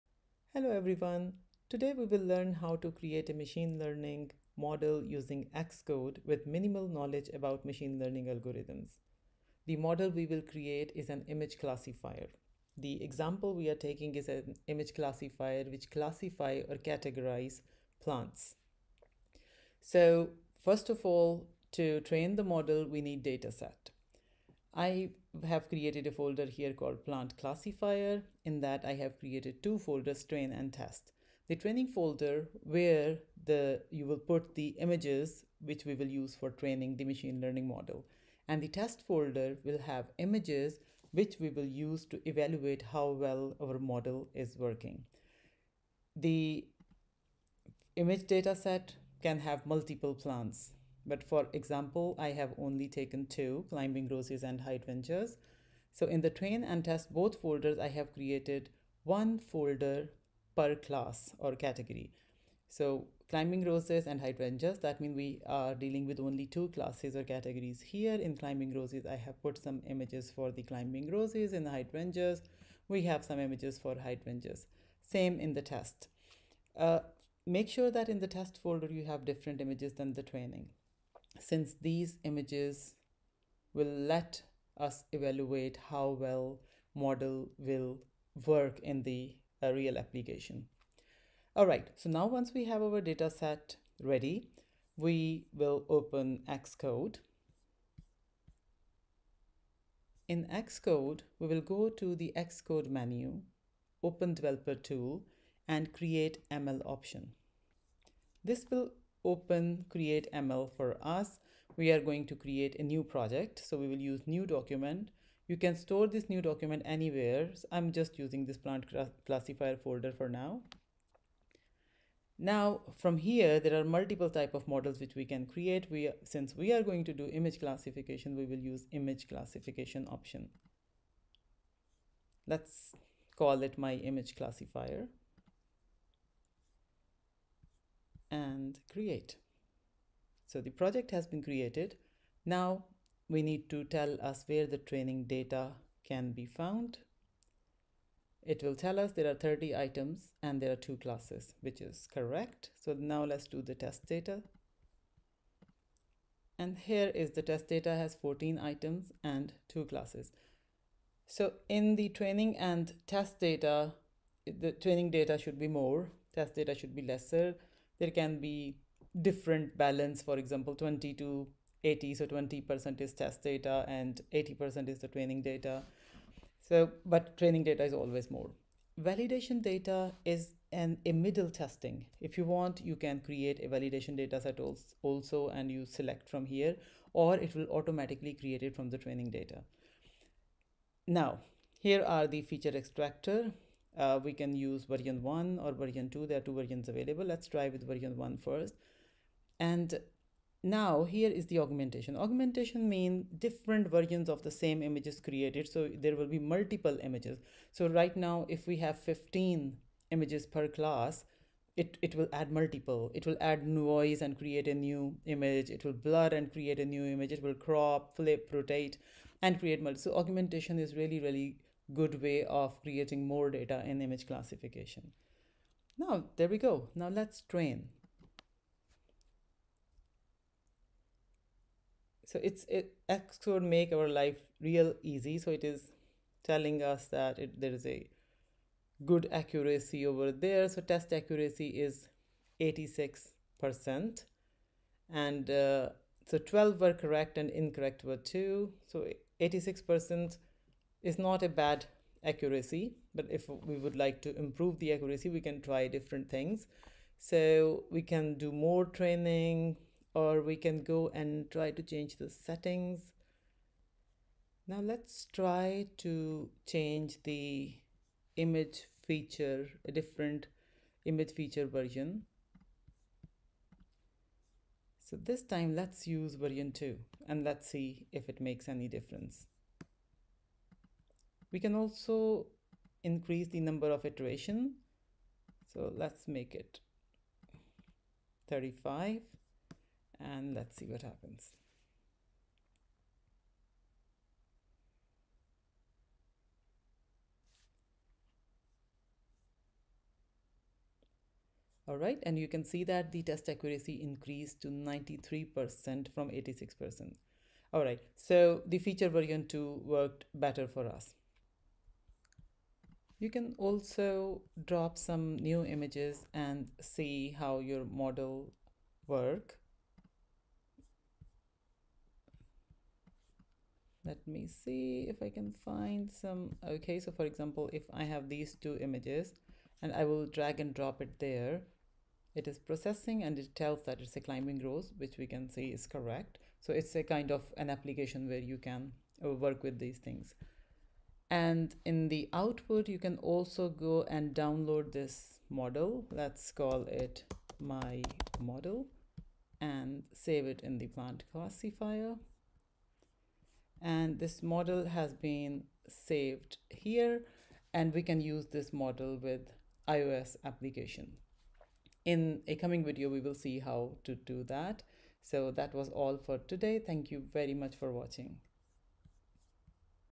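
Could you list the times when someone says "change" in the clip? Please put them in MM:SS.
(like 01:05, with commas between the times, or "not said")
04:21, 04:26.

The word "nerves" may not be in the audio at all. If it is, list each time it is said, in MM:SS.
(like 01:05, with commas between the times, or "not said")
not said.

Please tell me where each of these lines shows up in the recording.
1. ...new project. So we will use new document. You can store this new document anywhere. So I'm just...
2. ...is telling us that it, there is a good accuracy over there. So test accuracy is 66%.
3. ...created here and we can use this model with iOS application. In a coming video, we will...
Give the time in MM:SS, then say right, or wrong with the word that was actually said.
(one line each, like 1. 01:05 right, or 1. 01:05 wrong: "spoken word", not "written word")
1. 01:52 right
2. 03:55 wrong: "86", not "66"
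3. 05:55 wrong: "saved", not "created".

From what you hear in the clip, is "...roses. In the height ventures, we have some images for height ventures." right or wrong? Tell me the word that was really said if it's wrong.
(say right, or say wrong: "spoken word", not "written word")
right.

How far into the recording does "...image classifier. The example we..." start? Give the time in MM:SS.
00:11.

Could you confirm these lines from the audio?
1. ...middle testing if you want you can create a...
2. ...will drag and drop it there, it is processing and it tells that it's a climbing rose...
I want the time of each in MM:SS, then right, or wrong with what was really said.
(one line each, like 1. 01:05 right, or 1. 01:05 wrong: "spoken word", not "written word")
1. 03:01 right
2. 05:30 right.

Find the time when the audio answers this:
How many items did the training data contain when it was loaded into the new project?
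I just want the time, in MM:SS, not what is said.
02:29.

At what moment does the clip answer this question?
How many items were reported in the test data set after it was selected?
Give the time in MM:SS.
02:38.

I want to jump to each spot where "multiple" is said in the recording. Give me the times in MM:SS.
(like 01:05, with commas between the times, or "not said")
00:49, 02:03, 03:26, 03:32, 03:39.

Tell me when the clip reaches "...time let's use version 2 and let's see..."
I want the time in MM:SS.
04:35.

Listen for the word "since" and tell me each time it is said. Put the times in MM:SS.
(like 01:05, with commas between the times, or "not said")
01:21, 02:06.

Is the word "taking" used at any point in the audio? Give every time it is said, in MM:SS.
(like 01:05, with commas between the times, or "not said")
00:13.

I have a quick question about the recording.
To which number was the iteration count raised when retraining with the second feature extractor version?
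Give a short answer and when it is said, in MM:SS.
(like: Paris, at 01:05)
35, at 04:48.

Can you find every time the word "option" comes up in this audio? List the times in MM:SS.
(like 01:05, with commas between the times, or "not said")
01:46, 02:10.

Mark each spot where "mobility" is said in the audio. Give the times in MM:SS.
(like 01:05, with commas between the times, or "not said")
not said.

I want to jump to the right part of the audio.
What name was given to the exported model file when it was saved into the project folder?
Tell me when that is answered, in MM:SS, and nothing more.
05:47.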